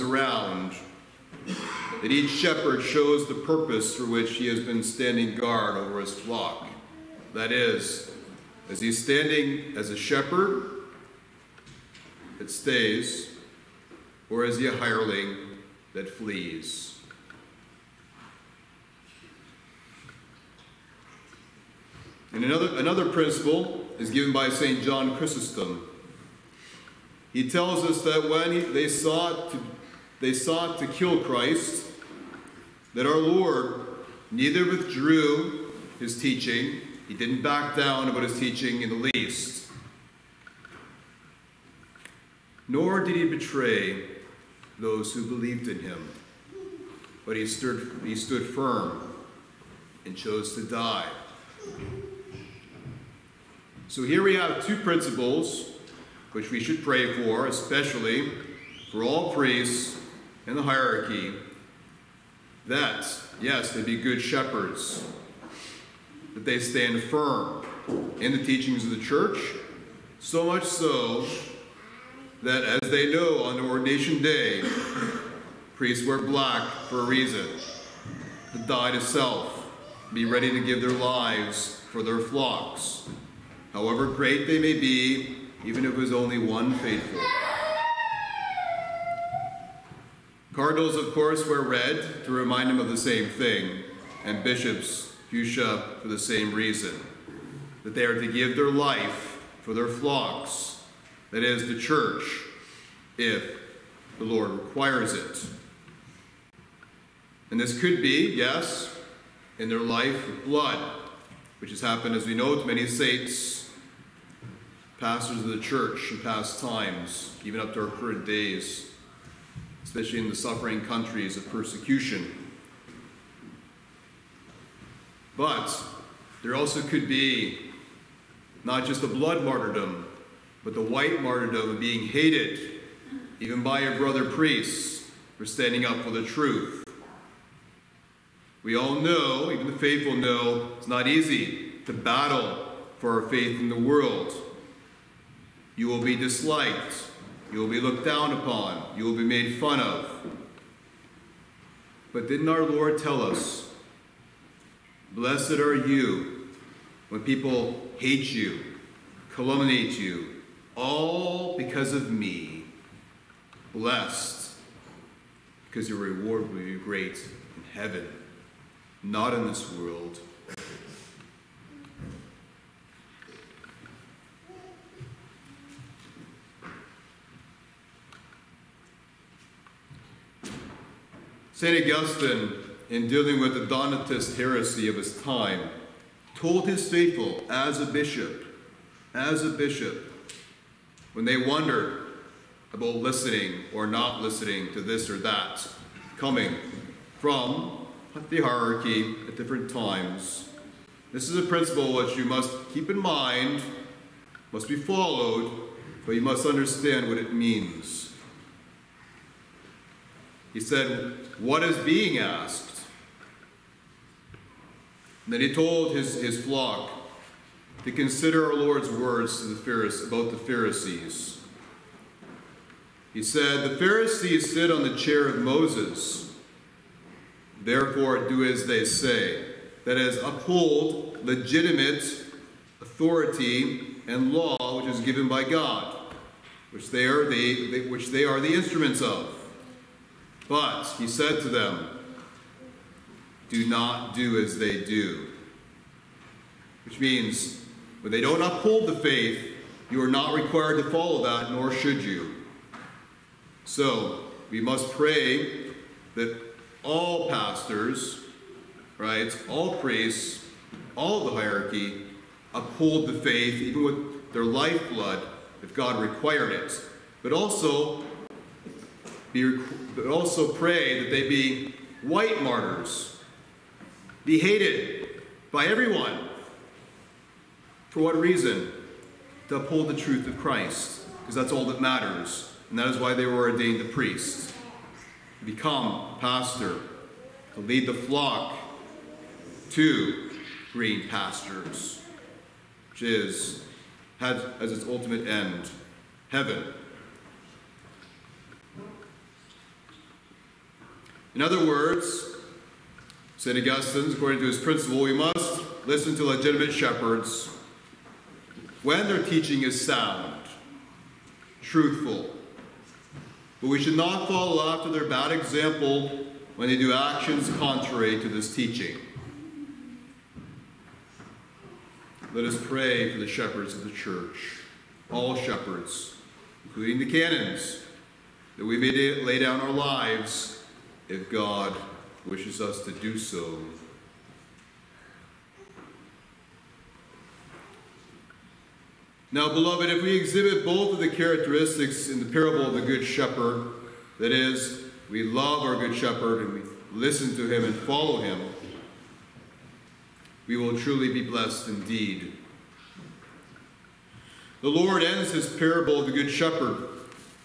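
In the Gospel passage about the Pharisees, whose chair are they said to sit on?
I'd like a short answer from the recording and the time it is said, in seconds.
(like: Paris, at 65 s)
Moses, at 225 s.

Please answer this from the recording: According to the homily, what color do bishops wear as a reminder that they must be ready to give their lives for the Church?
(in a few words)
Fuchsia.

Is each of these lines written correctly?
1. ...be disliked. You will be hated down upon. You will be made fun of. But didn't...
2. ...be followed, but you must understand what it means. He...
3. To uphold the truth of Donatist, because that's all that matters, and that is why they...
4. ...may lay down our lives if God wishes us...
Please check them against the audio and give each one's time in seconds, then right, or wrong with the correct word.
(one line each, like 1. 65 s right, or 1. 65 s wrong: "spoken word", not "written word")
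1. 146 s wrong: "looked", not "hated"
2. 204 s right
3. 279 s wrong: "Christ", not "Donatist"
4. 328 s right.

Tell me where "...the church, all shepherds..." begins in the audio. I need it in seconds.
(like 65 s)
323 s.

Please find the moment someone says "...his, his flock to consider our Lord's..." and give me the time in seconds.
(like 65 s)
215 s.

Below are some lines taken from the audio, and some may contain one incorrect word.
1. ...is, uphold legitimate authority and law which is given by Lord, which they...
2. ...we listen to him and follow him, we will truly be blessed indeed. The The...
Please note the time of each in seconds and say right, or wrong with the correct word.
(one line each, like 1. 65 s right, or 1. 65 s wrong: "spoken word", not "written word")
1. 229 s wrong: "God", not "Lord"
2. 346 s wrong: "Lord", not "The".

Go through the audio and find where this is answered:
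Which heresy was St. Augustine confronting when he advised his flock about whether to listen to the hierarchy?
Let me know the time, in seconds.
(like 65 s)
183 s.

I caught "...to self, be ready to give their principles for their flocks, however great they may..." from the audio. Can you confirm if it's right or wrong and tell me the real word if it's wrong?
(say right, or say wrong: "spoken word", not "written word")
wrong: "lives", not "principles".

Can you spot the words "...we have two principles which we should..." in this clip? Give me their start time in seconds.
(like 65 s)
54 s.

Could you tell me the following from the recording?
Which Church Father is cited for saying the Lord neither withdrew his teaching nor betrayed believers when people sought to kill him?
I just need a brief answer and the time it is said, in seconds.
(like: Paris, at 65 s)
St. John Chrysostom, at 24 s.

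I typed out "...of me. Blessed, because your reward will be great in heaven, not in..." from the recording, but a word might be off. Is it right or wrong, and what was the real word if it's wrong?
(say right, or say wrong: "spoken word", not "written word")
right.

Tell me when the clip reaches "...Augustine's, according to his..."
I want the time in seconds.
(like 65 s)
303 s.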